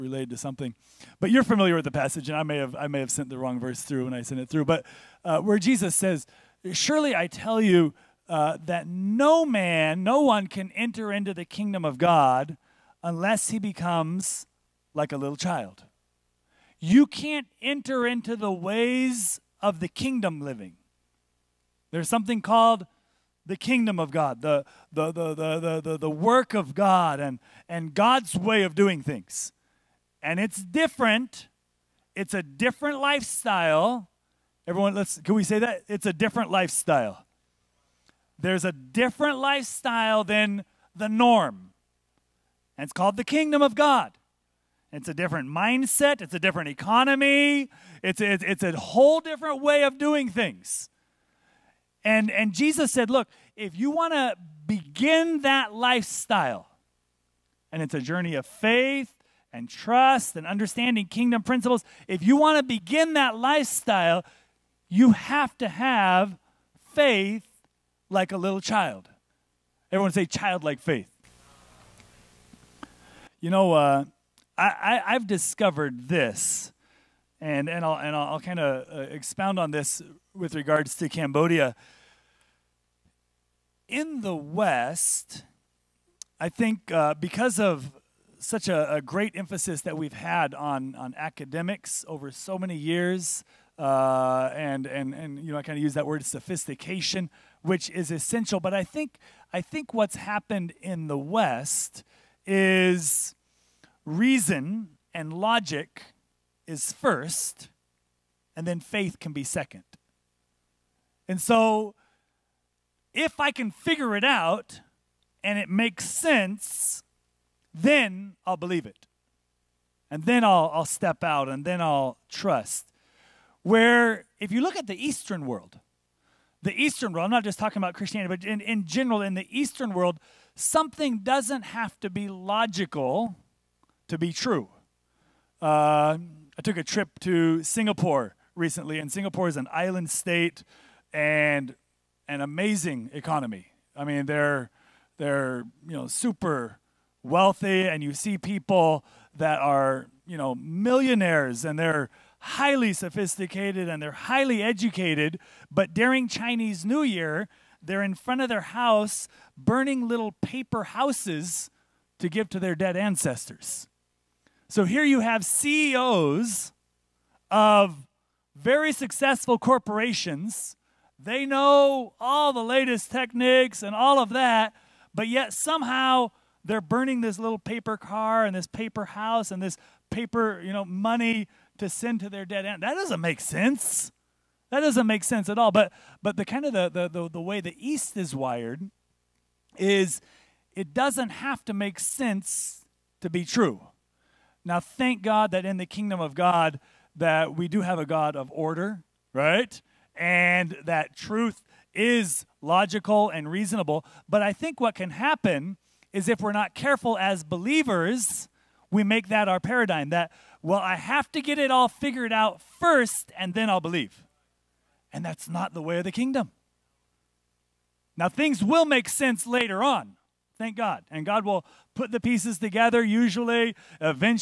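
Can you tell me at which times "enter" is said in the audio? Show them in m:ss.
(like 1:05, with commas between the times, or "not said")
0:10, 0:17.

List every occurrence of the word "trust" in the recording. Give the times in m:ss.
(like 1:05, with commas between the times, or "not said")
0:59, 2:02.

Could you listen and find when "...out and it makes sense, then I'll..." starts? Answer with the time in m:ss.
1:54.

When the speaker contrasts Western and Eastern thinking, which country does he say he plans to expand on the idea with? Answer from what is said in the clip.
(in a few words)
Cambodia.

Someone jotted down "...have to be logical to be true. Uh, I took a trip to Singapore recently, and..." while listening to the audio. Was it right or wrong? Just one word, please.
right.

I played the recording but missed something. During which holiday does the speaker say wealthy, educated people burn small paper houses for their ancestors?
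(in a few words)
Chinese New Year.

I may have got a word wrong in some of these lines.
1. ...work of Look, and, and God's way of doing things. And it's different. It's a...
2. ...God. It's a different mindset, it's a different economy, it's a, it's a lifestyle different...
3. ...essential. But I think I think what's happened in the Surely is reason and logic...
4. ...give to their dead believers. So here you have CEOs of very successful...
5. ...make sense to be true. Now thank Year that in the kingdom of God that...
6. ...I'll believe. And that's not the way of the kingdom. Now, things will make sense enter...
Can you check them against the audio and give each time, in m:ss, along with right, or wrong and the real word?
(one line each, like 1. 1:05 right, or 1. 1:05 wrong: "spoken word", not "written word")
1. 0:26 wrong: "God", not "Look"
2. 0:43 wrong: "whole", not "lifestyle"
3. 1:38 wrong: "West", not "Surely"
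4. 2:42 wrong: "ancestors", not "believers"
5. 3:11 wrong: "God", not "Year"
6. 3:33 wrong: "later", not "enter".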